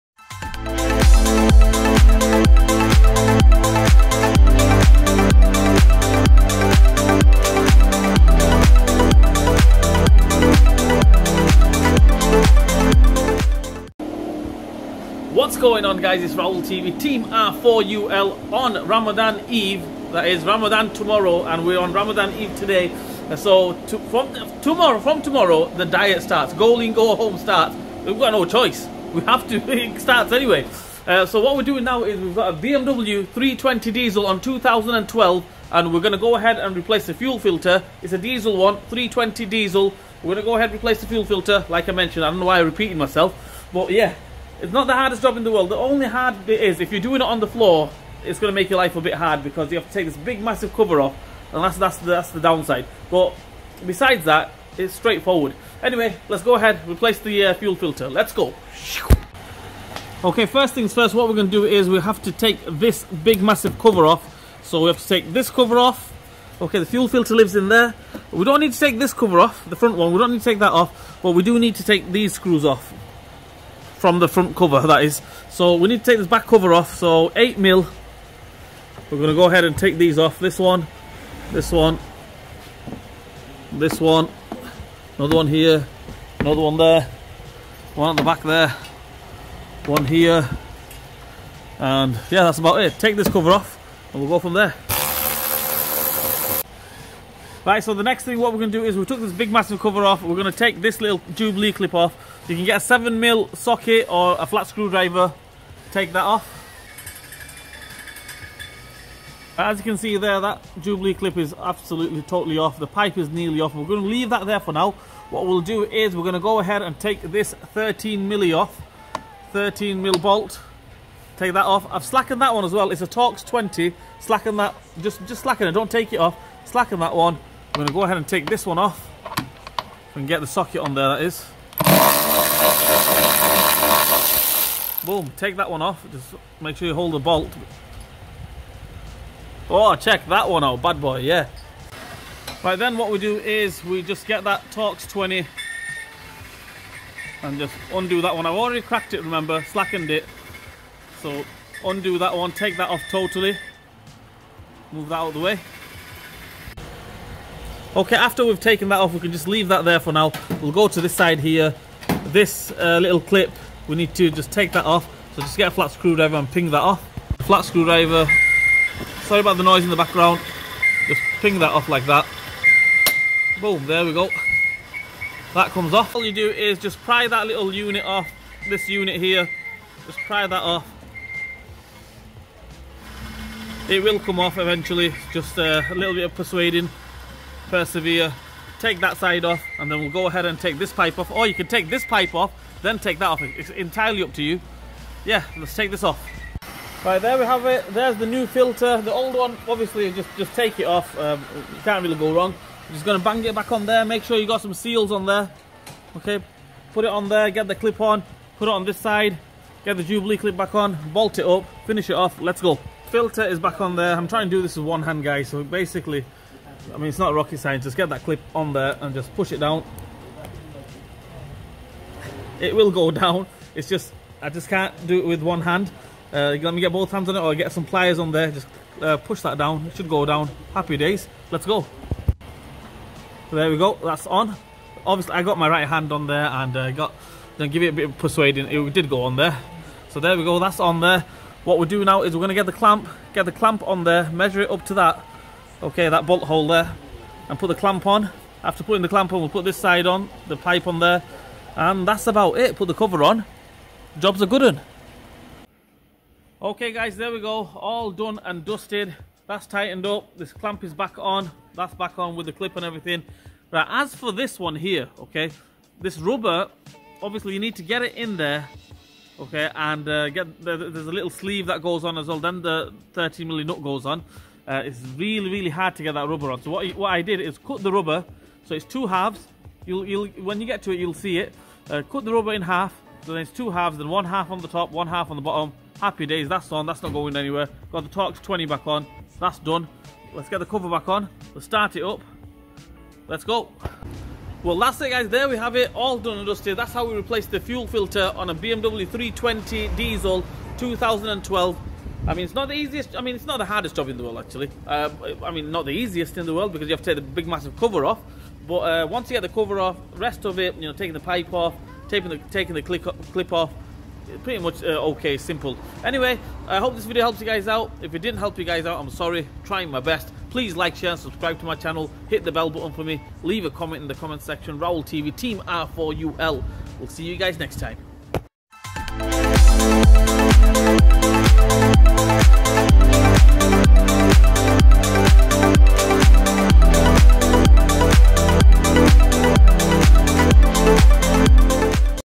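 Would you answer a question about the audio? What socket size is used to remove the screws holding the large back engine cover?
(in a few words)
8 mm.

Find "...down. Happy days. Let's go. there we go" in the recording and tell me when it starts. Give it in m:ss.
3:50.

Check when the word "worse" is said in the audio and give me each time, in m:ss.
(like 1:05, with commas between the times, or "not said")
not said.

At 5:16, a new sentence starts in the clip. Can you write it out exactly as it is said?
Anyway, I hope this video helps you guys out.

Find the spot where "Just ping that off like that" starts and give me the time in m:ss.
2:51.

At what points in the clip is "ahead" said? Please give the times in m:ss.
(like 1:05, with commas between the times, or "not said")
0:36, 0:40, 0:56, 1:19, 1:56, 2:08, 3:10.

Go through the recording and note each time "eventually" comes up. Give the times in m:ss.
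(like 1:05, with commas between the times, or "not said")
3:04.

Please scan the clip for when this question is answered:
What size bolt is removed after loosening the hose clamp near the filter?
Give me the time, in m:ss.
1:57.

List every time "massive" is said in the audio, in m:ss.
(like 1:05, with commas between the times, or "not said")
0:50, 1:03, 1:39, 5:07.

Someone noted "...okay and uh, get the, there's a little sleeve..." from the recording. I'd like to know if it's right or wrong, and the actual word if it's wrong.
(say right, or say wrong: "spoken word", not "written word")
right.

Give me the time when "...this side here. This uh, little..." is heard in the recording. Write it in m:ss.
2:41.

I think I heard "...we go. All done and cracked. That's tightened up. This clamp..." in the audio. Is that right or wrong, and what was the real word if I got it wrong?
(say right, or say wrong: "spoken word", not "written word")
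wrong: "dusted", not "cracked".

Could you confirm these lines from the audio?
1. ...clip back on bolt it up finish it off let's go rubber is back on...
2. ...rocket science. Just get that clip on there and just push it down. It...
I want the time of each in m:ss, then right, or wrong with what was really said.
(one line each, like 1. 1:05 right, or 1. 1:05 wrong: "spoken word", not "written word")
1. 3:30 wrong: "filter", not "rubber"
2. 3:37 right.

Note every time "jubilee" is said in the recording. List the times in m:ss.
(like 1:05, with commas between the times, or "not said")
1:41, 1:50, 3:30.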